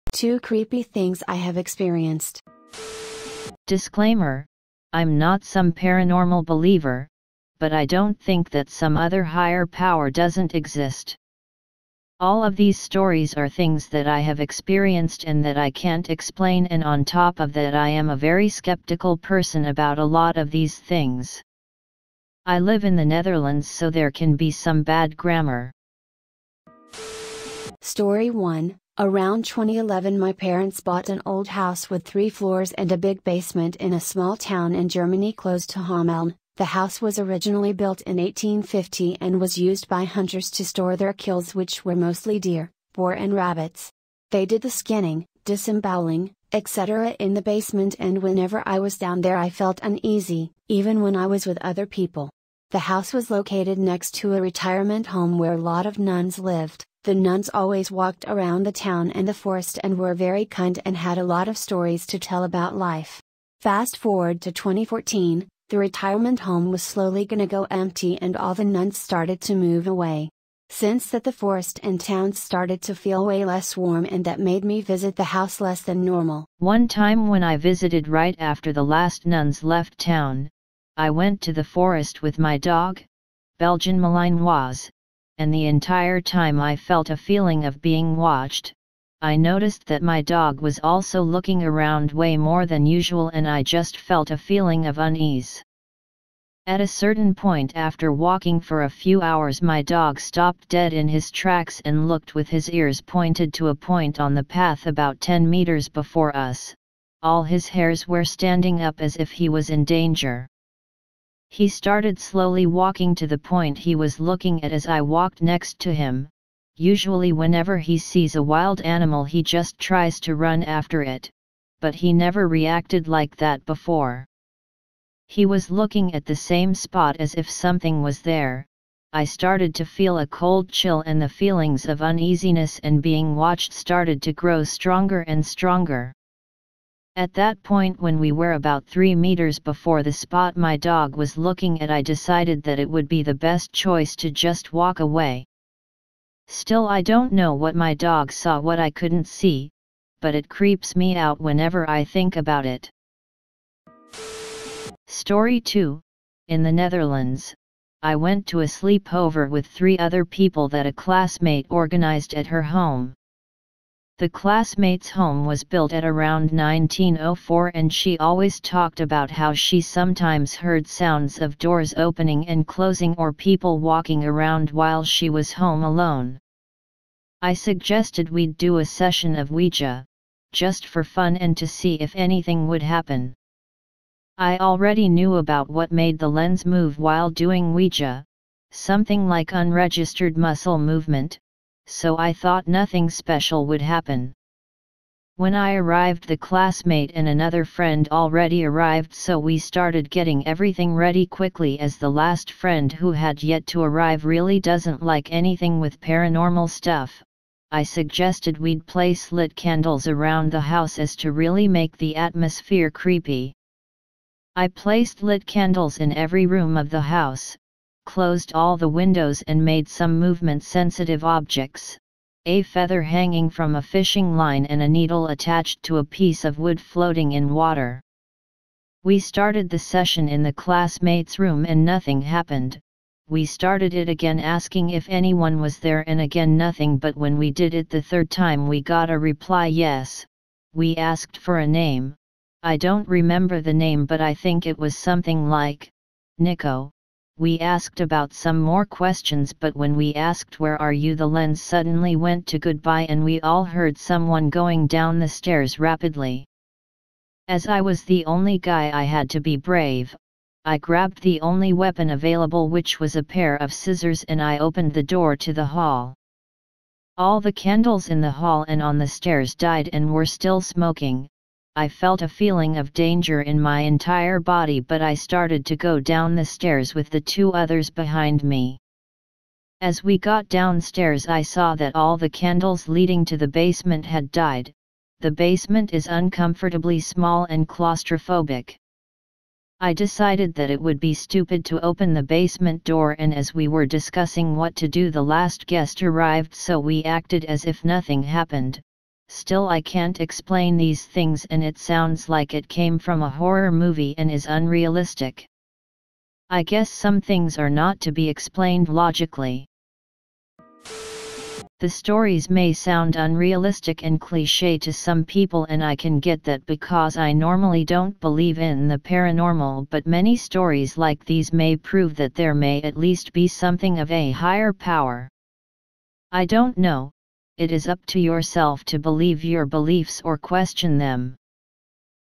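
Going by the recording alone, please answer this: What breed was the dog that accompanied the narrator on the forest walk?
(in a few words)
Belgian Malinois.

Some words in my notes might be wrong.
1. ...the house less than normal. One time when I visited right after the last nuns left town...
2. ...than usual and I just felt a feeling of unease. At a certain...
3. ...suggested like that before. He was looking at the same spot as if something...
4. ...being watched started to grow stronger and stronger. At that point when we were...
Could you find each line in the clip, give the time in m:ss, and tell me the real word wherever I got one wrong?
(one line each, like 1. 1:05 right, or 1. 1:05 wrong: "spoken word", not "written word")
1. 1:15 right
2. 1:32 right
3. 2:02 wrong: "reacted", not "suggested"
4. 2:13 right.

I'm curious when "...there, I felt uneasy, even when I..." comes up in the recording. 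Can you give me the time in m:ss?
0:49.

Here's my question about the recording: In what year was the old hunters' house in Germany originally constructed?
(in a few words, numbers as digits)
1850.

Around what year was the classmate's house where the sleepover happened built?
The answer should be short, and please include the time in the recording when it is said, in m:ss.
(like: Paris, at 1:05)
1904, at 2:46.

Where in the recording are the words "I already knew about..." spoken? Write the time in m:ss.
3:04.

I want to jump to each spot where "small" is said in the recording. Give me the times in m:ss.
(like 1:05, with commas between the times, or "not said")
0:33, 4:46.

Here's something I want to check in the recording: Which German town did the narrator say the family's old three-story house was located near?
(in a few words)
Hameln.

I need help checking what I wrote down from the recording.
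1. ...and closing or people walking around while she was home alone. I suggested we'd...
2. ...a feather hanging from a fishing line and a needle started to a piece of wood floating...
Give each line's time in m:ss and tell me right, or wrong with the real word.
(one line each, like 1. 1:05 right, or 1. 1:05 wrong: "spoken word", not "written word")
1. 2:52 right
2. 3:42 wrong: "attached", not "started".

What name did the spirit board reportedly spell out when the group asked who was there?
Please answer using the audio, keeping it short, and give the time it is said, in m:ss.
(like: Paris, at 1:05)
Nico, at 4:06.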